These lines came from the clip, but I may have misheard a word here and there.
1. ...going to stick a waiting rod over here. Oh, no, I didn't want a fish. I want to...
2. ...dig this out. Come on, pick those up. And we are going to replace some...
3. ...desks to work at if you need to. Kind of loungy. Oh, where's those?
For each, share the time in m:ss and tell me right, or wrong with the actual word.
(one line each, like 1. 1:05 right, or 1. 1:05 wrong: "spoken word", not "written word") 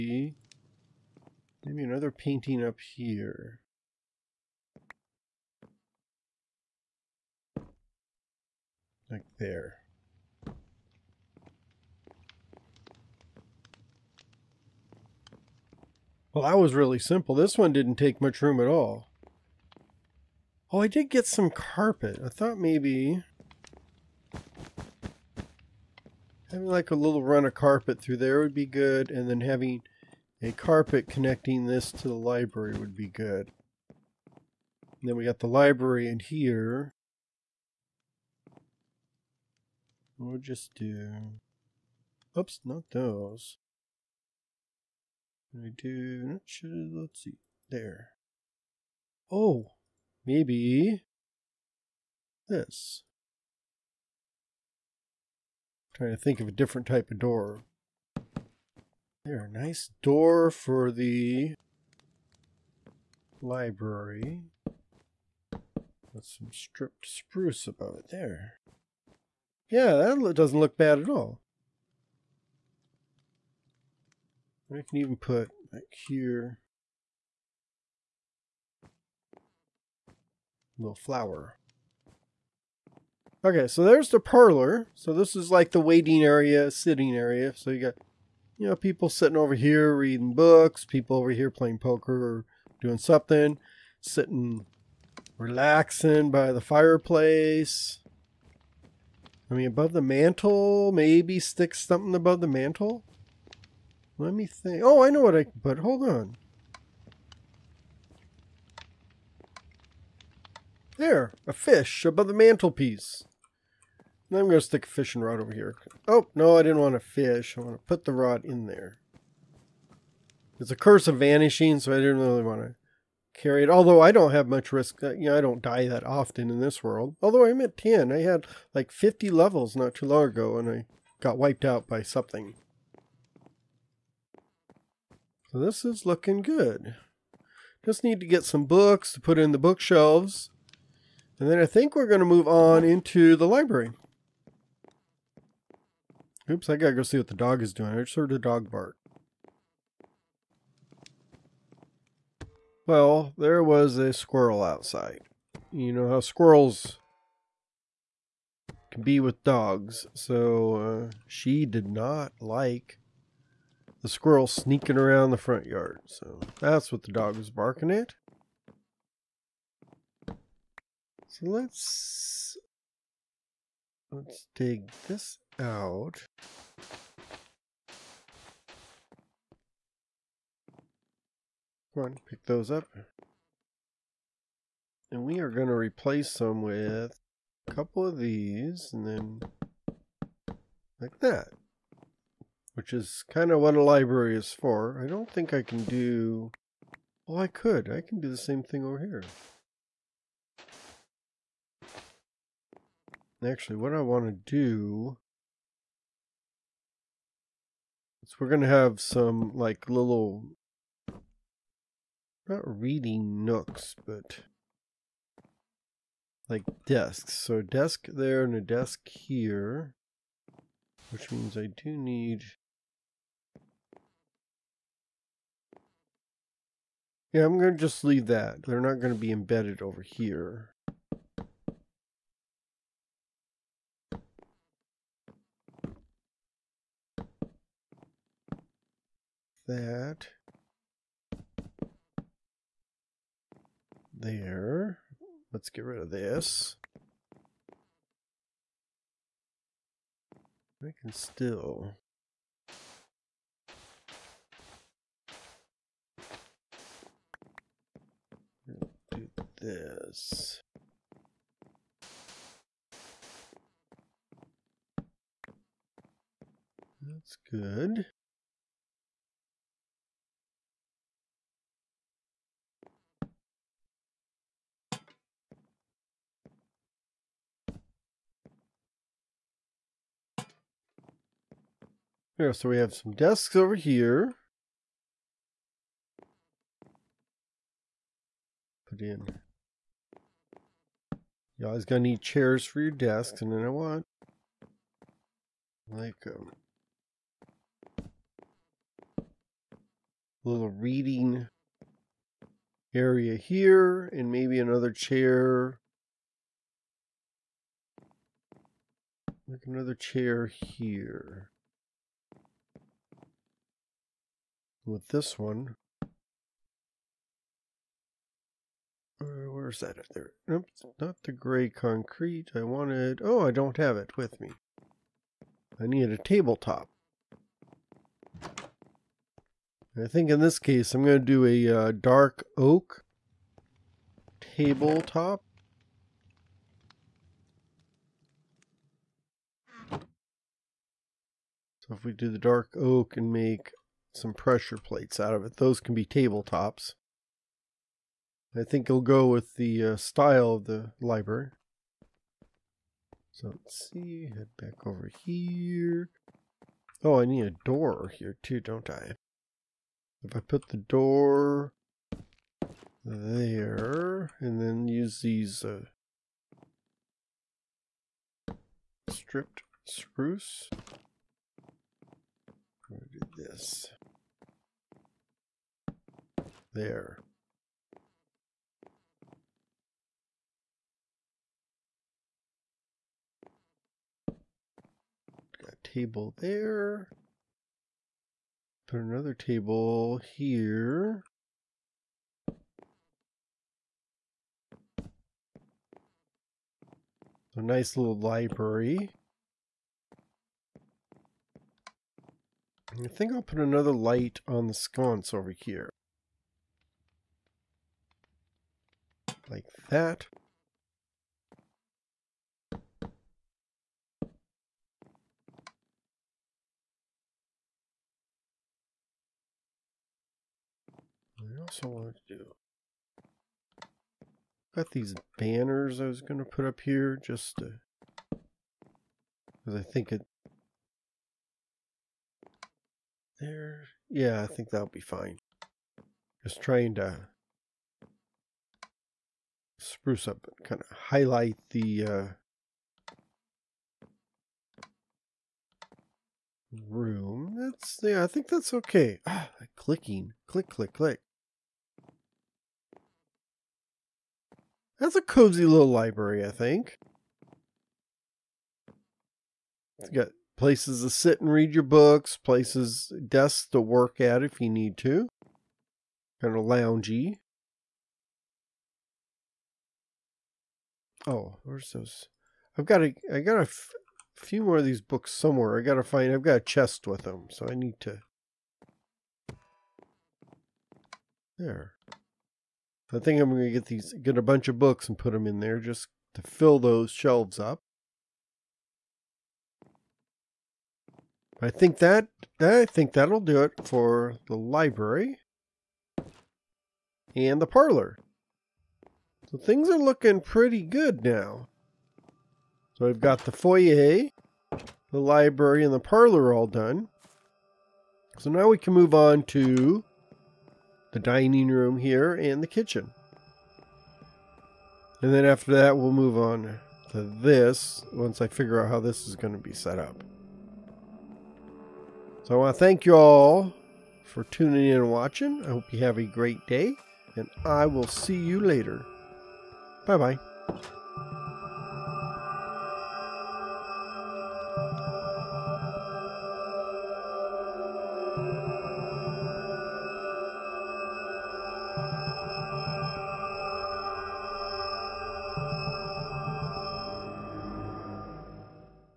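1. 1:54 wrong: "fishing", not "waiting"
2. 2:54 right
3. 7:43 right.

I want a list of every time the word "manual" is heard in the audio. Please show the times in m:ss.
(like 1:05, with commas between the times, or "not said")
not said.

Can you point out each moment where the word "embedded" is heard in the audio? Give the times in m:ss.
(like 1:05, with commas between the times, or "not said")
3:49.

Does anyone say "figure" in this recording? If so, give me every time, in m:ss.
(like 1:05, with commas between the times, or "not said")
8:38.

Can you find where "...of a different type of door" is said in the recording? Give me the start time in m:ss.
0:56.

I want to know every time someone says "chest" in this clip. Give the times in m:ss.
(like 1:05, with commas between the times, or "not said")
7:56.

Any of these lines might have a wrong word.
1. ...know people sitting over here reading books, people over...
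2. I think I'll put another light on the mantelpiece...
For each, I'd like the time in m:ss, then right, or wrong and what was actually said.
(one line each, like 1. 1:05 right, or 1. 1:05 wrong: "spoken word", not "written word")
1. 1:28 right
2. 6:42 wrong: "sconce", not "mantelpiece".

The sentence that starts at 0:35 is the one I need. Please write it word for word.
And then we got the library in here.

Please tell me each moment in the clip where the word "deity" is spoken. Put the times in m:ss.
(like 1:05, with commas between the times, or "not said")
not said.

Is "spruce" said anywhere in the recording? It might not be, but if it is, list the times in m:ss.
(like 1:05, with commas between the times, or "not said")
1:07, 6:09, 7:19.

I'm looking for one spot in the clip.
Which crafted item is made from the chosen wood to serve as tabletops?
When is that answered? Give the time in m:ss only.
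5:44.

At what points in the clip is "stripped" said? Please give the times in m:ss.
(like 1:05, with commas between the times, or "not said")
1:06, 6:09.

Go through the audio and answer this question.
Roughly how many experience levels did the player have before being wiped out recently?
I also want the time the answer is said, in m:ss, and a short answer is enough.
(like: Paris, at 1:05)
50, at 2:08.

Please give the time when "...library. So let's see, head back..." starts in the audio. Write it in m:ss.
5:51.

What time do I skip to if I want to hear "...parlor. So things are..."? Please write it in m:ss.
8:17.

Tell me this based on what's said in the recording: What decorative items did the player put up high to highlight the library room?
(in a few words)
Banners.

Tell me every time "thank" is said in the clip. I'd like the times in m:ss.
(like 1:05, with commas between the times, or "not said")
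8:42.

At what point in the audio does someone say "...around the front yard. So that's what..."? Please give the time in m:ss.
2:44.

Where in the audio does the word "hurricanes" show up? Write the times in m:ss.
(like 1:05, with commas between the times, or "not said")
not said.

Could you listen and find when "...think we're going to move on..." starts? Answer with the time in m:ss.
2:21.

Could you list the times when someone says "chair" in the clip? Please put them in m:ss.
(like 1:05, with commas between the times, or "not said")
4:52, 5:04, 5:09.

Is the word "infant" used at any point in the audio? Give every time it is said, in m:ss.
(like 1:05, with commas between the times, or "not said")
not said.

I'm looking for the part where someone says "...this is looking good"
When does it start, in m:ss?
2:15.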